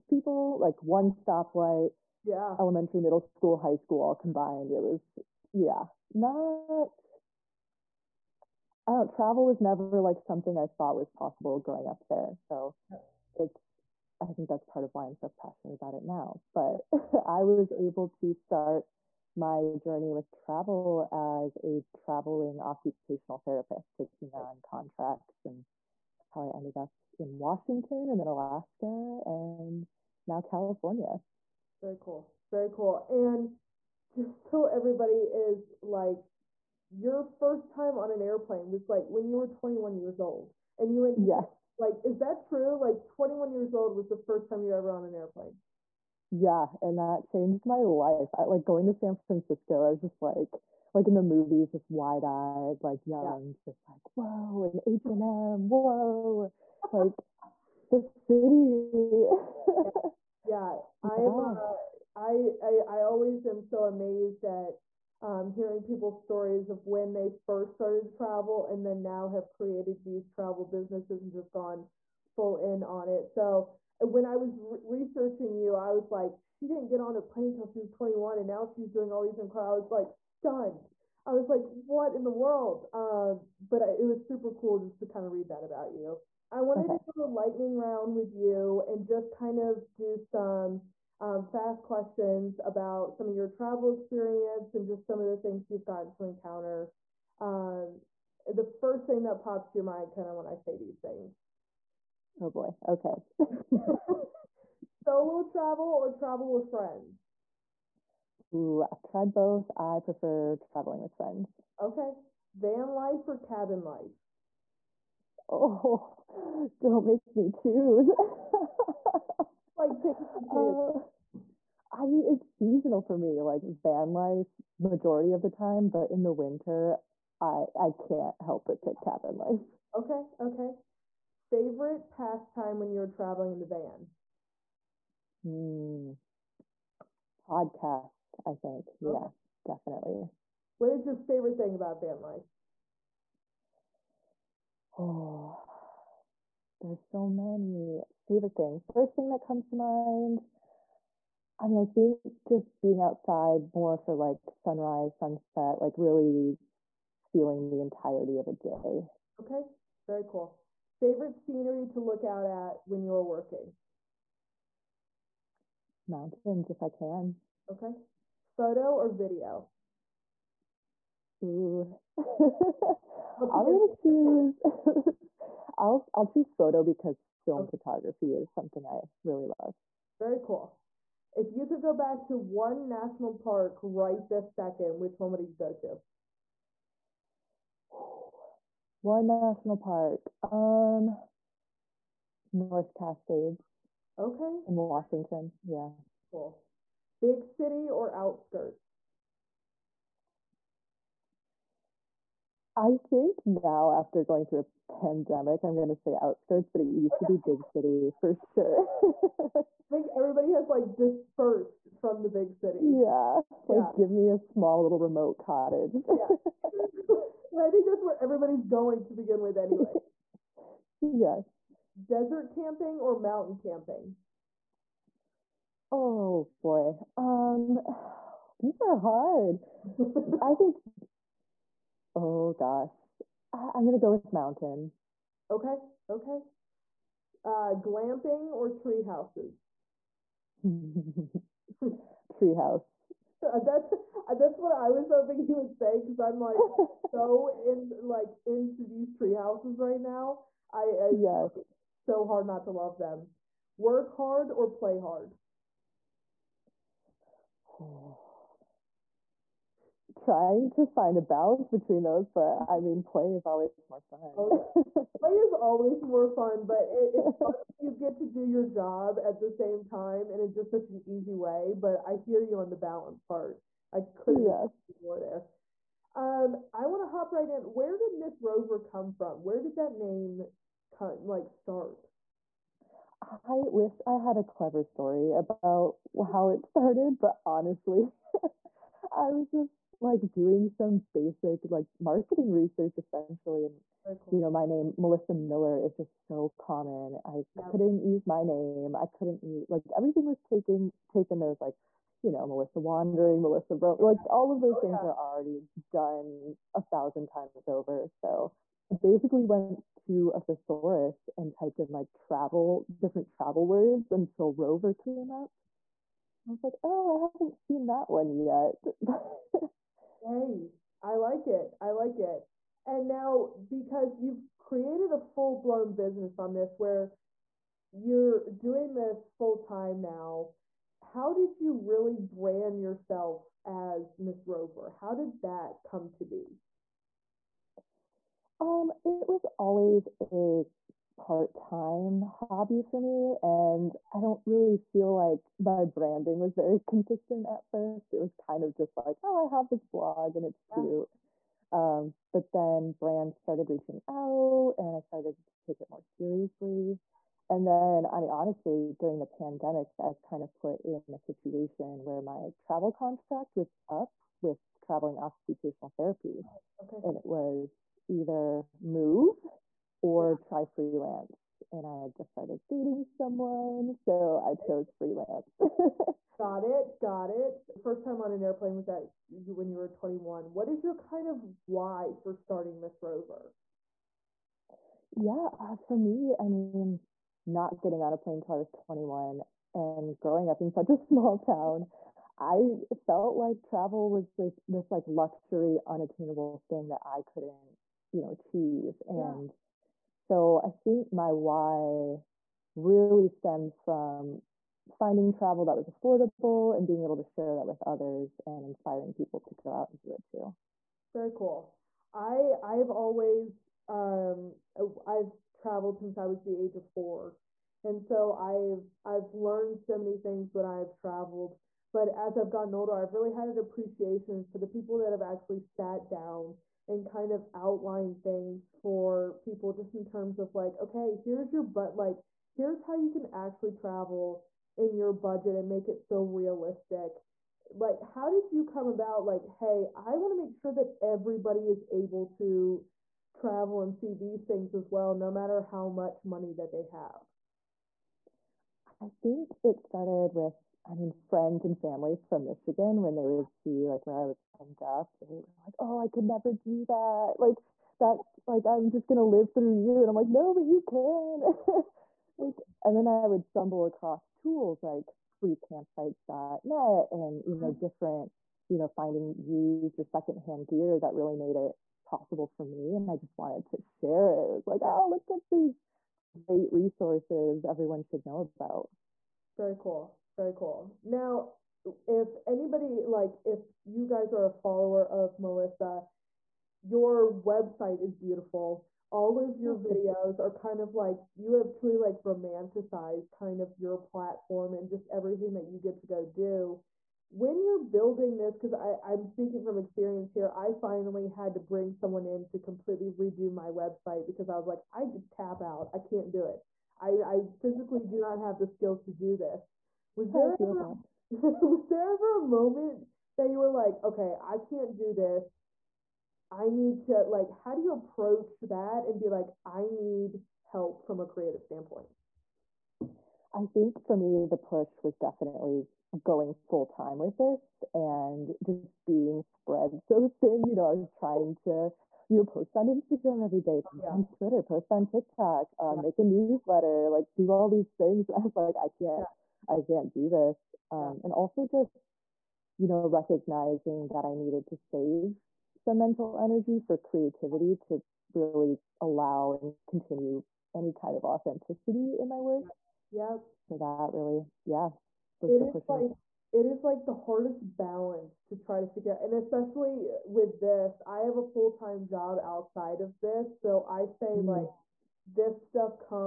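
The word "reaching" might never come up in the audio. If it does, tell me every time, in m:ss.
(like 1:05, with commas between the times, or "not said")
5:53.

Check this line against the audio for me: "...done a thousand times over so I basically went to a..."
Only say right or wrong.
right.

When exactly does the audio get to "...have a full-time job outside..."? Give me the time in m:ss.
9:21.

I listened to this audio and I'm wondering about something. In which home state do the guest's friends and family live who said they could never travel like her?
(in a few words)
Michigan.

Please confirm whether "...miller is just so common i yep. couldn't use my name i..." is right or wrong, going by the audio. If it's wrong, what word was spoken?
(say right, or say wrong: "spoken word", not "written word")
right.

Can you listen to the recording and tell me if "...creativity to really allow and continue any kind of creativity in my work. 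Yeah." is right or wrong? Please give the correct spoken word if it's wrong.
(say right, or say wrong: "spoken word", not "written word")
wrong: "authenticity", not "creativity".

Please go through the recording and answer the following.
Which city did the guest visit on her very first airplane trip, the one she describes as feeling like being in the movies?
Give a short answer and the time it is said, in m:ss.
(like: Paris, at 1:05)
San Francisco, at 0:48.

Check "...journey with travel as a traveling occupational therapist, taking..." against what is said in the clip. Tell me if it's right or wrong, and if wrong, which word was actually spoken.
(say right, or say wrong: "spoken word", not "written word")
right.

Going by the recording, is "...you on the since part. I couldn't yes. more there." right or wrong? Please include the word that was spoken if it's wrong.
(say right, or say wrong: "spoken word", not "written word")
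wrong: "balance", not "since".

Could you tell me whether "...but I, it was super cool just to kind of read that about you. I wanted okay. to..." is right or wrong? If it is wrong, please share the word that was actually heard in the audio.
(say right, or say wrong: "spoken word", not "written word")
right.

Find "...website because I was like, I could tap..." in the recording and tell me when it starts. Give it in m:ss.
8:23.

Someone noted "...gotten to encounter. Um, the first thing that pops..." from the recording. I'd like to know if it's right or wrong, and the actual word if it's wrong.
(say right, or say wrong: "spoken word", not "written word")
right.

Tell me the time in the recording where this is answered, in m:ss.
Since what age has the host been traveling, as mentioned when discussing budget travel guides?
6:56.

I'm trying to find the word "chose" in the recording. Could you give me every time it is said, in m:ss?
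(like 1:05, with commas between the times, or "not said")
6:14.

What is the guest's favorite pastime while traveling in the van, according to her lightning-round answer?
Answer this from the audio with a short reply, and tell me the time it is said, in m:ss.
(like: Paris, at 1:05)
Podcasts, at 2:17.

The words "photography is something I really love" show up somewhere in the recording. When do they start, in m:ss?
2:57.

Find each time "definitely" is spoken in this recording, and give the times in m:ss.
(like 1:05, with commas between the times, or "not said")
2:19, 8:45.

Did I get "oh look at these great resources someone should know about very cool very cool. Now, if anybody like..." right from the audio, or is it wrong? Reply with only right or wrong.
wrong.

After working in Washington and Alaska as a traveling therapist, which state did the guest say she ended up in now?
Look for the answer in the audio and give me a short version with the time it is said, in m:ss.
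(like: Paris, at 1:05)
California, at 0:30.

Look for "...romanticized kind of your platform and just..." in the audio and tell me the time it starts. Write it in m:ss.
8:12.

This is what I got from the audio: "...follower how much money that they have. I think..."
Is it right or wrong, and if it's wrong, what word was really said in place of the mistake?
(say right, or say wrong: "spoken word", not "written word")
wrong: "matter", not "follower".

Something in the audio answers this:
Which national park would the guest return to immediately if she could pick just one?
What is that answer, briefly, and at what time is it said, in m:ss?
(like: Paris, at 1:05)
North Cascades, at 3:12.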